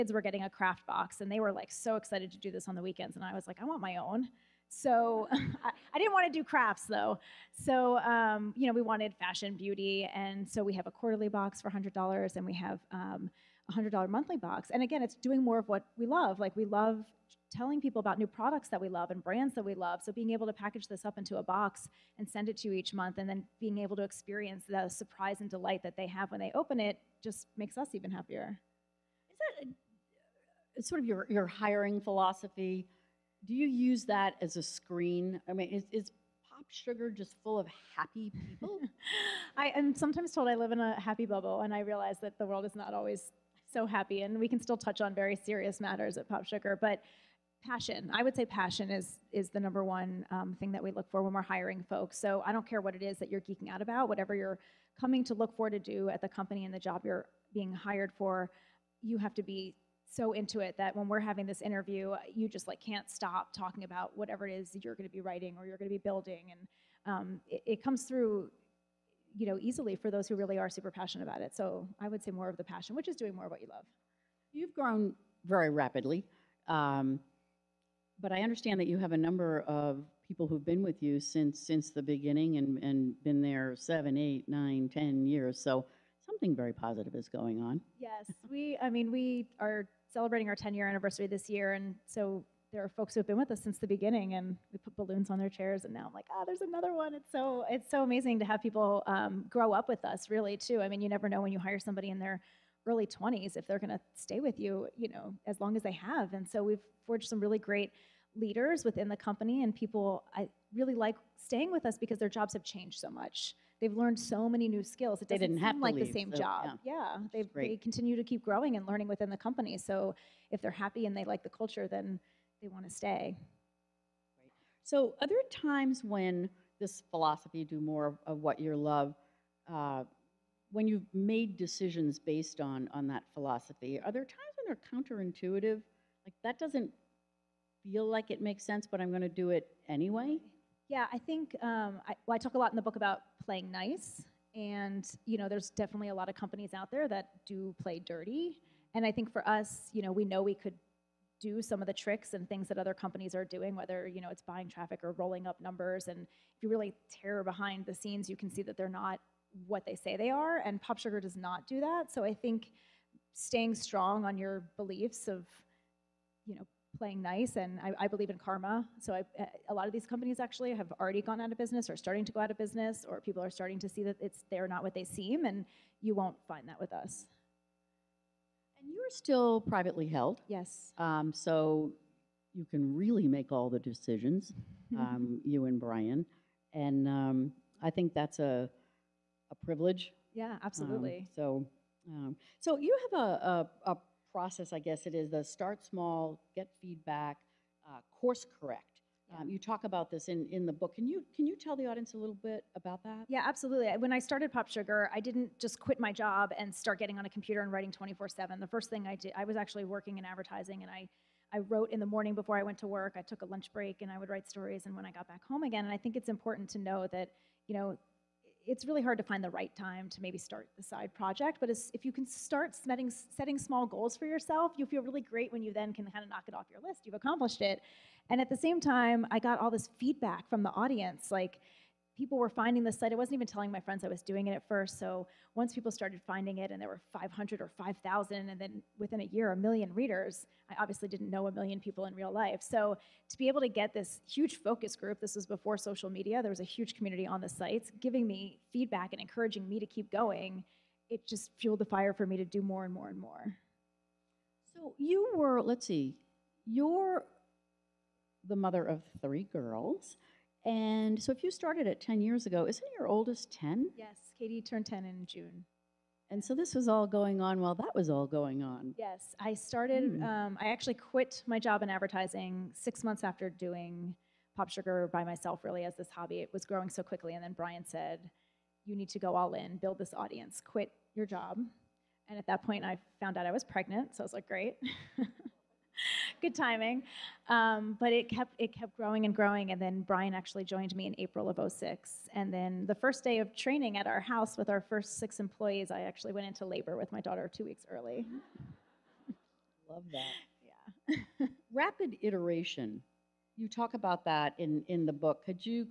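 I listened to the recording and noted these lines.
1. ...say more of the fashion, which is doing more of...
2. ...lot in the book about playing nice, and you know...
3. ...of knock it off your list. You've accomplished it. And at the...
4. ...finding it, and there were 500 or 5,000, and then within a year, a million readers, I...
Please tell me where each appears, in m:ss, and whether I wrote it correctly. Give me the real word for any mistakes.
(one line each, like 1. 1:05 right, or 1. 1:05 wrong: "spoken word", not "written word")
1. 1:12 wrong: "passion", not "fashion"
2. 2:22 right
3. 3:46 right
4. 3:56 right.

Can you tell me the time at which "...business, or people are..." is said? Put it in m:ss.
2:52.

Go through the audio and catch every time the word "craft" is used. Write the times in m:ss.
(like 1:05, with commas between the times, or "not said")
0:00, 0:06.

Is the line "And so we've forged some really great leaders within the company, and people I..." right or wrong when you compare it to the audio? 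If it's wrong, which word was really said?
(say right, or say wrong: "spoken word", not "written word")
right.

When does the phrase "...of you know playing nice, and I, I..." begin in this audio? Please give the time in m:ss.
2:45.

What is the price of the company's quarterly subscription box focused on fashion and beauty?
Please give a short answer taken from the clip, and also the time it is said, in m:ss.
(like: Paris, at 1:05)
$100, at 0:10.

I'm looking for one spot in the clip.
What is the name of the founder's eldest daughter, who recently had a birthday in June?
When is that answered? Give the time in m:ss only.
4:24.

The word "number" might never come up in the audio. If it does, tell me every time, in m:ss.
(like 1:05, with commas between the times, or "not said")
0:49, 1:19, 2:35.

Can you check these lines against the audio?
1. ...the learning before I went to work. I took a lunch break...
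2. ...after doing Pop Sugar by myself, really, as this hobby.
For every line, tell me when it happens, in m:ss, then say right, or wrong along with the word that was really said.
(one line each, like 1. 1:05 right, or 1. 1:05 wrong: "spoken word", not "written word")
1. 3:32 wrong: "morning", not "learning"
2. 4:33 right.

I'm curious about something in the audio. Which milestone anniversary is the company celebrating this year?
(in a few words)
10 year.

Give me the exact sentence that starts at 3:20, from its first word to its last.
Can you can you tell the audience a little bit about that?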